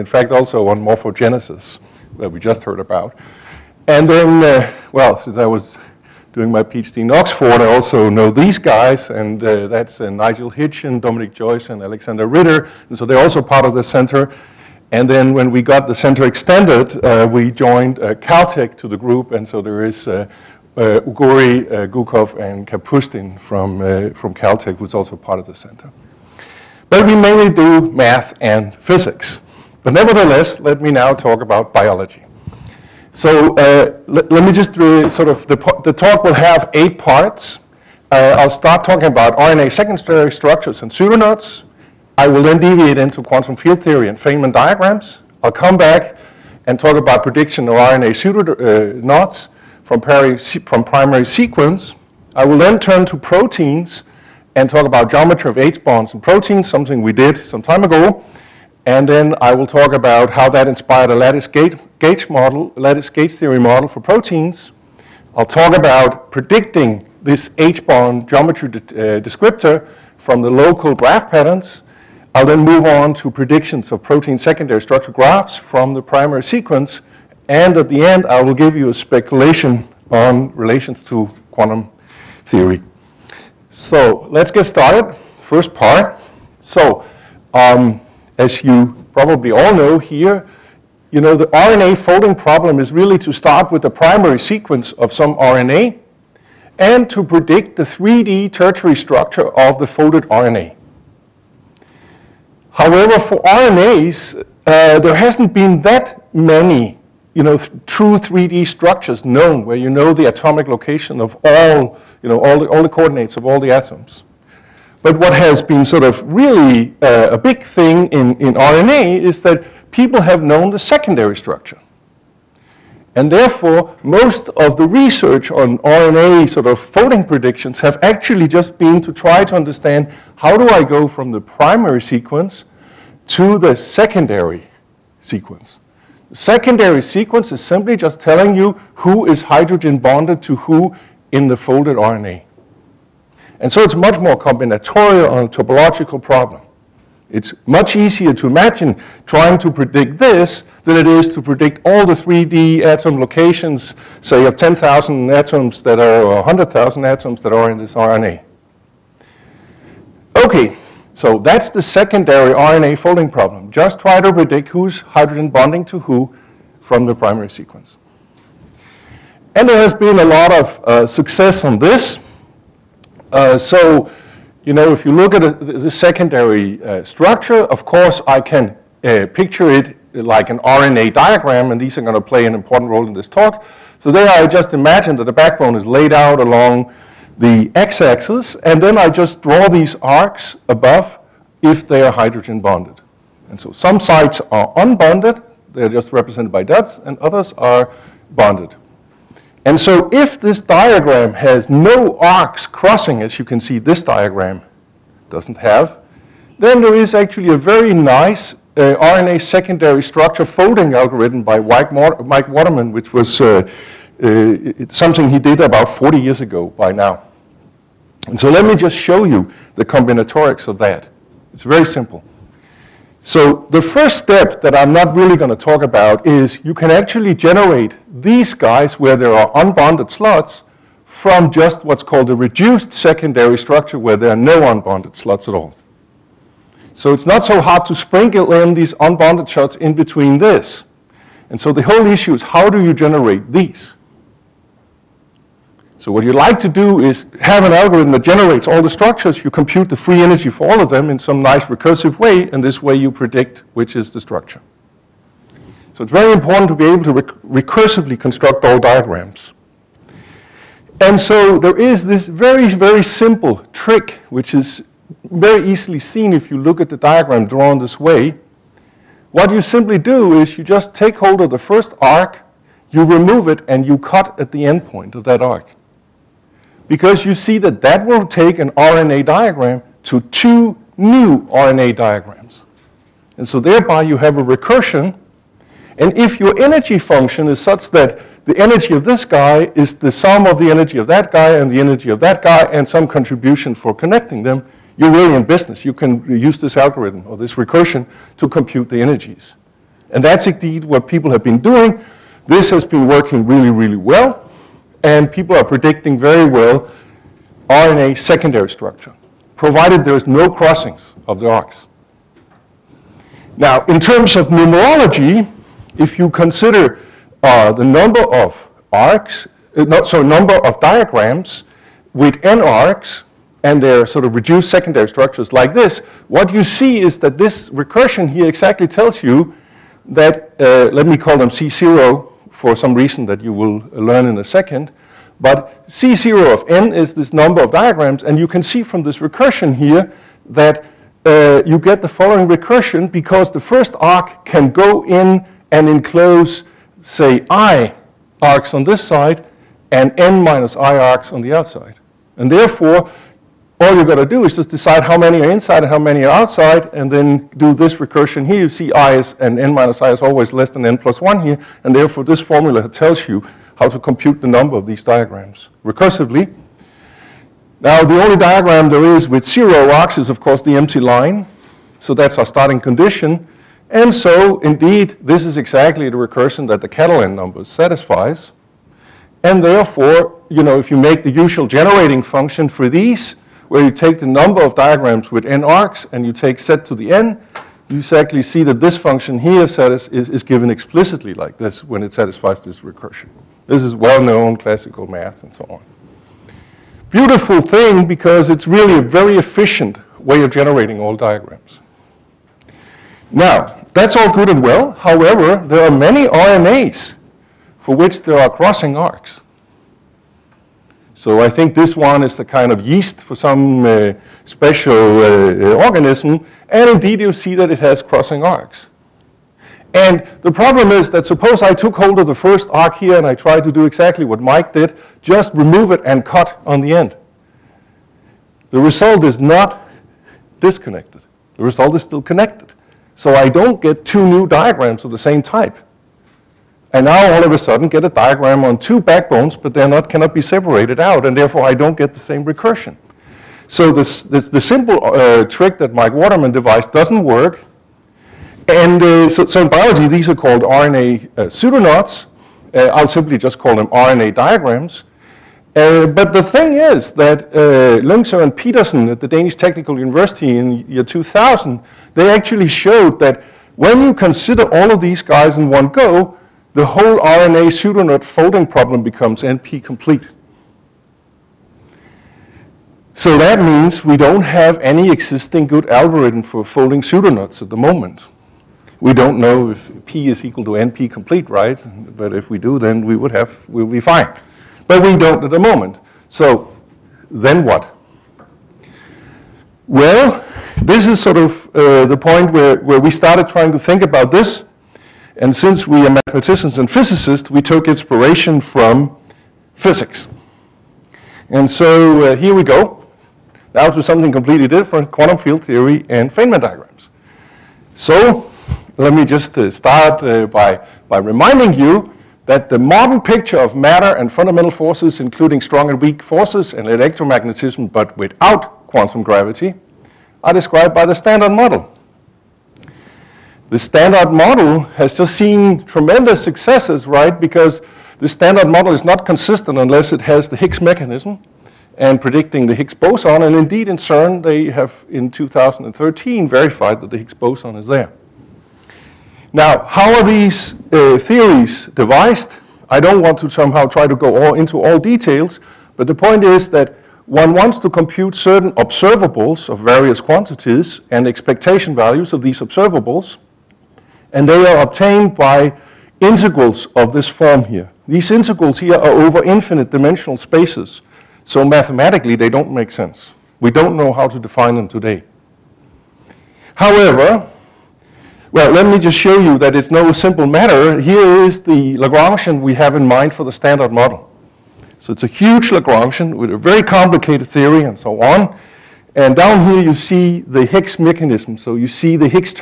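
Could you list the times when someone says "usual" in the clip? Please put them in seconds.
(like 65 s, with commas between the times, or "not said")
381 s.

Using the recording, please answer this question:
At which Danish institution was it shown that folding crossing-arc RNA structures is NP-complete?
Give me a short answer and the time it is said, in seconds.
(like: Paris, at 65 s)
Danish Technical University, at 459 s.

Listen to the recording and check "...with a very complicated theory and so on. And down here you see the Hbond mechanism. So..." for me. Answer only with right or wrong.
wrong.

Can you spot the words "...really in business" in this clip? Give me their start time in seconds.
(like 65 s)
295 s.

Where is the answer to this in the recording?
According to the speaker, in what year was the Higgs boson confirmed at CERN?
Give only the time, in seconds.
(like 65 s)
535 s.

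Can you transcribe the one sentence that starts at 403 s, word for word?
Now, that's all good and well.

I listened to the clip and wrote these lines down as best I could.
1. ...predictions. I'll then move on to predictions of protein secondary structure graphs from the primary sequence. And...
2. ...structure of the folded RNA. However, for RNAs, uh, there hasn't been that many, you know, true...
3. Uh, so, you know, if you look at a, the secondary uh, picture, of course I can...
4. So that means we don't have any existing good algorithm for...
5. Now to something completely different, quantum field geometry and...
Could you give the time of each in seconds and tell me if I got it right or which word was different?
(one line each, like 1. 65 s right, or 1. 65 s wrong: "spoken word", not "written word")
1. 71 s wrong: "patterns", not "predictions"
2. 98 s right
3. 173 s wrong: "structure", not "picture"
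4. 473 s right
5. 503 s wrong: "theory", not "geometry".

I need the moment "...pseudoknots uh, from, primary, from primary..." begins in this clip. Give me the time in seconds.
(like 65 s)
48 s.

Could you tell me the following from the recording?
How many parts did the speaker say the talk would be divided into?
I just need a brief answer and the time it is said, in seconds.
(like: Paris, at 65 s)
8, at 36 s.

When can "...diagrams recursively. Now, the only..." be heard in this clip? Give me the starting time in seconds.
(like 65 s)
365 s.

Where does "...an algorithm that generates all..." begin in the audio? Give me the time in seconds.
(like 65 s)
247 s.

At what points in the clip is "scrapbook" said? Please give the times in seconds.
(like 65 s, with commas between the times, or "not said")
not said.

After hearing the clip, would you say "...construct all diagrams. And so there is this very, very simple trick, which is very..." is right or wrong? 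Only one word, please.
right.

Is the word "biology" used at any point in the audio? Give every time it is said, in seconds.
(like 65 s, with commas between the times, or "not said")
31 s, 449 s.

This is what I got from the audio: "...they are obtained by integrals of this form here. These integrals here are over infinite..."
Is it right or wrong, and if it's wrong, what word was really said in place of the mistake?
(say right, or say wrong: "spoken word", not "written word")
right.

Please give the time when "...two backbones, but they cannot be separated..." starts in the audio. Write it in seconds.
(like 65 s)
438 s.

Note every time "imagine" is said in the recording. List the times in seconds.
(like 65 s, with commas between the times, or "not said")
148 s, 184 s.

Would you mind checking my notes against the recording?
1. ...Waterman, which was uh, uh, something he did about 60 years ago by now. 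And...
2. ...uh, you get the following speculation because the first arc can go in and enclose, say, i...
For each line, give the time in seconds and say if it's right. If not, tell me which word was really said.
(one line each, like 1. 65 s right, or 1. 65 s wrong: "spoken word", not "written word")
1. 212 s wrong: "40", not "60"
2. 341 s wrong: "recursion", not "speculation".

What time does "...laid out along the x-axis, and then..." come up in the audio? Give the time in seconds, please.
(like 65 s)
185 s.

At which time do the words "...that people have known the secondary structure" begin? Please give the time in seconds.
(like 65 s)
119 s.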